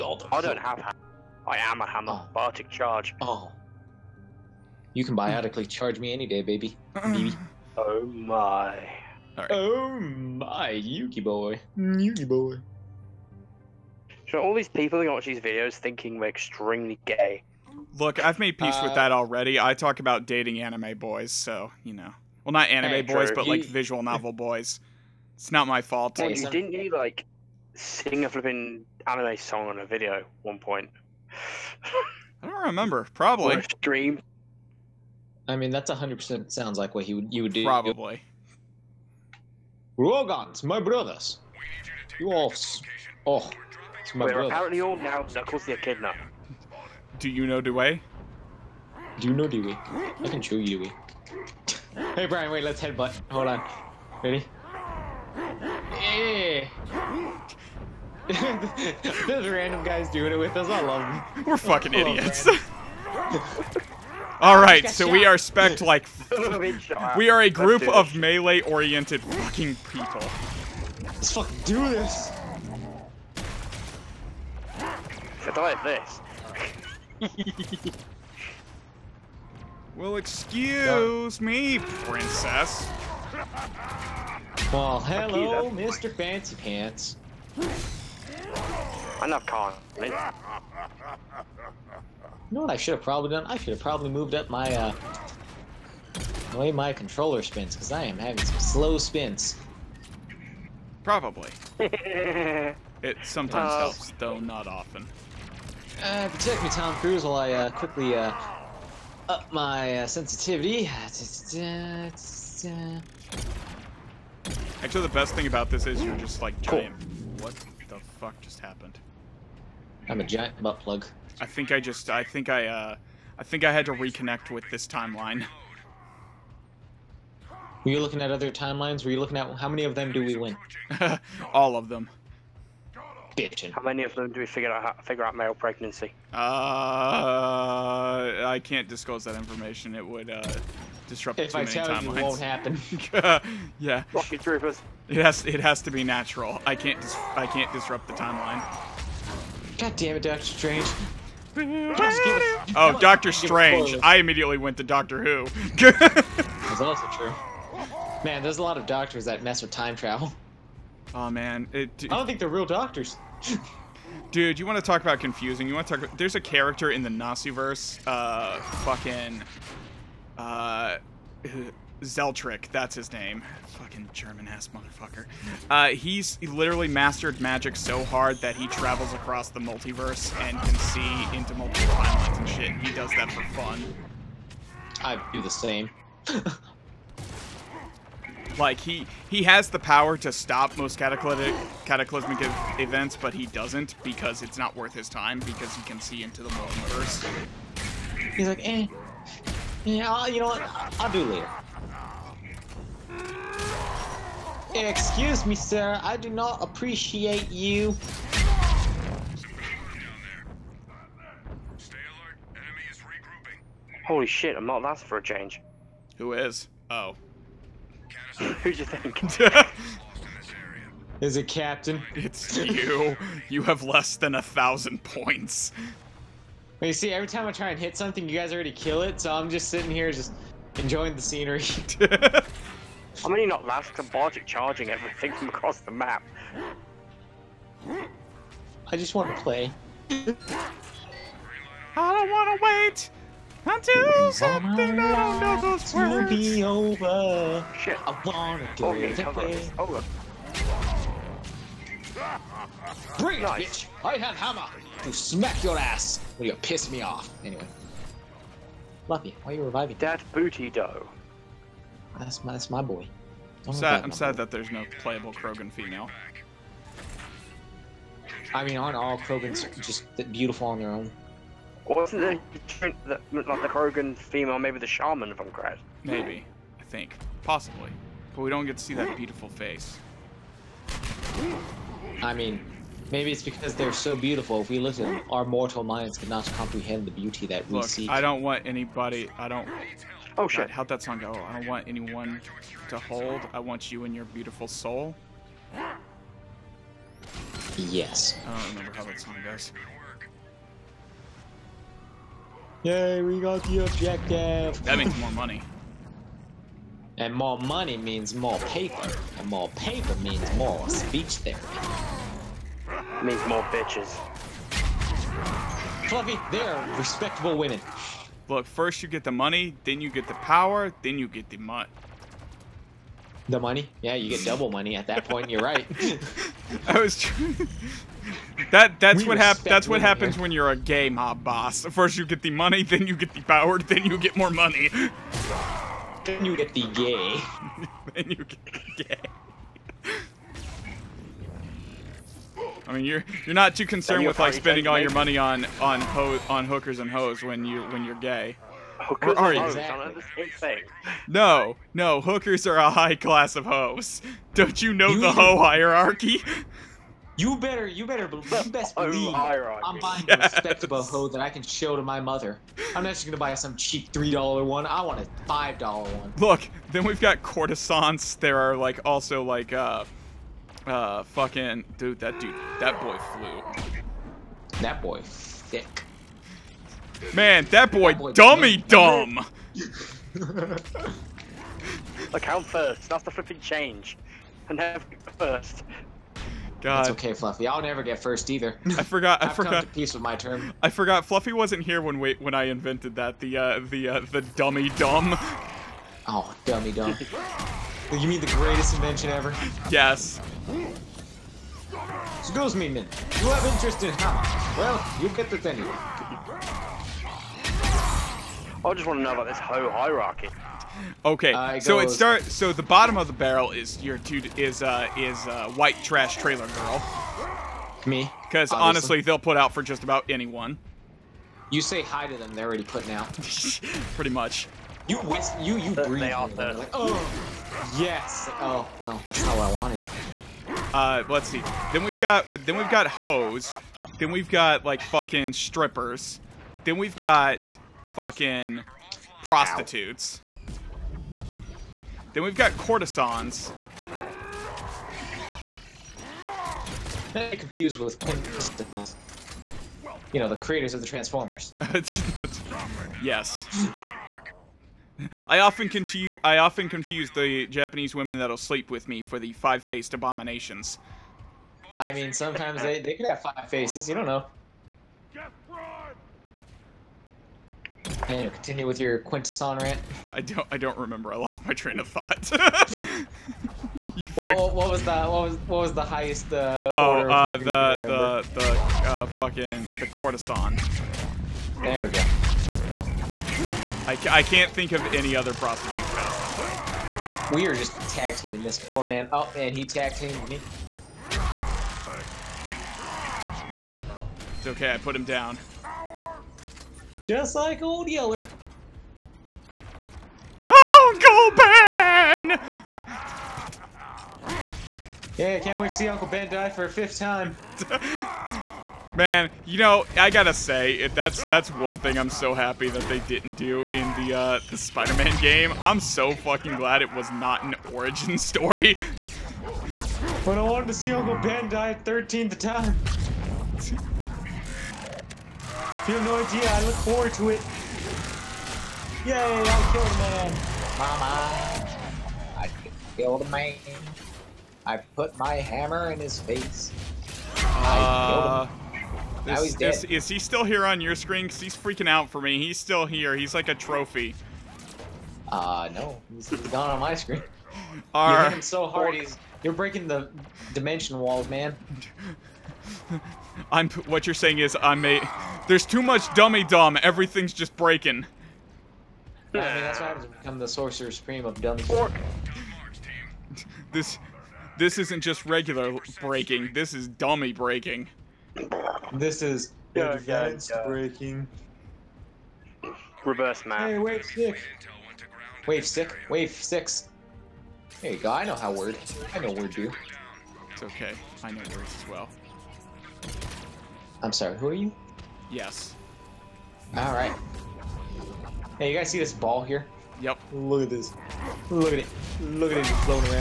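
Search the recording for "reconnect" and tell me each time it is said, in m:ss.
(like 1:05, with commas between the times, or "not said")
2:03.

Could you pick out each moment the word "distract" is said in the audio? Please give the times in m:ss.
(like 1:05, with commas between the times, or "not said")
not said.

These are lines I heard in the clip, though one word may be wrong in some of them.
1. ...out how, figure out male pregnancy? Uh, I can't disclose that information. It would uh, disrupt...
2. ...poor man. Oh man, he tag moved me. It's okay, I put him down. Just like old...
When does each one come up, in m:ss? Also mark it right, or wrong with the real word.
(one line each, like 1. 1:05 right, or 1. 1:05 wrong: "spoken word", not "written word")
1. 2:14 right
2. 8:08 wrong: "teamed", not "moved".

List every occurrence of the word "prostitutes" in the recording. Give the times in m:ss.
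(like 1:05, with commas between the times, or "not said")
7:19, 8:05.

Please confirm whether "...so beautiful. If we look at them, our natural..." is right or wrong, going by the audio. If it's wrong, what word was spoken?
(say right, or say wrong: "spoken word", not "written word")
wrong: "mortal", not "natural".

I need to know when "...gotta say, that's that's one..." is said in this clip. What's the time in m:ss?
8:30.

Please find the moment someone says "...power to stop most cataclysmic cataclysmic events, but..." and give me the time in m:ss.
3:09.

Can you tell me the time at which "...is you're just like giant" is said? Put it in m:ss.
1:55.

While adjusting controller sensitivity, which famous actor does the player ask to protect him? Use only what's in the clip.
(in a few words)
Tom Cruise.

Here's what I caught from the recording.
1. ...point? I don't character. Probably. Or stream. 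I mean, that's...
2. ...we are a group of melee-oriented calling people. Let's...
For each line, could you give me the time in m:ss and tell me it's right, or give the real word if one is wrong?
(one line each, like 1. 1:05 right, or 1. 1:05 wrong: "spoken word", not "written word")
1. 0:30 wrong: "remember", not "character"
2. 1:07 wrong: "fucking", not "calling".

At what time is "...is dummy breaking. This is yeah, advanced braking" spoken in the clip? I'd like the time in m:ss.
9:26.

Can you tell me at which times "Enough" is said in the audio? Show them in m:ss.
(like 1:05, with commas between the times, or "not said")
1:29.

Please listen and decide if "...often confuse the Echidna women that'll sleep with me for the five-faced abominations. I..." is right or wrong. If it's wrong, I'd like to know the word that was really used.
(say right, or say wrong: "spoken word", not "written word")
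wrong: "Japanese", not "Echidna".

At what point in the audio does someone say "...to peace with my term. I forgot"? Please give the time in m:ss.
6:29.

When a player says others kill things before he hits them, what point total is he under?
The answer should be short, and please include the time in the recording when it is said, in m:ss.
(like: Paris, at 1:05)
1000, at 3:44.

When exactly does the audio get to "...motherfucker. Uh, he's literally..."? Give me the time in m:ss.
2:54.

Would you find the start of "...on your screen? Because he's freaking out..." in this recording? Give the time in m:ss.
9:00.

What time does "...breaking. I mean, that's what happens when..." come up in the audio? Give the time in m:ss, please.
9:17.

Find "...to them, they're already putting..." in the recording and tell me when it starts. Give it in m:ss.
7:02.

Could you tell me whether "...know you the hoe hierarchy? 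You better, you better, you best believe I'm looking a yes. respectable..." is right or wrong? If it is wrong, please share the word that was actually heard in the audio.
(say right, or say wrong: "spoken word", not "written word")
wrong: "buying", not "looking".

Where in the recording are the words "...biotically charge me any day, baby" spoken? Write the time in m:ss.
0:05.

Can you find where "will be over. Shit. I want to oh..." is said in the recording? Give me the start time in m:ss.
4:06.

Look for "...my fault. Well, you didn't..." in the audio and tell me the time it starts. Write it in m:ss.
0:25.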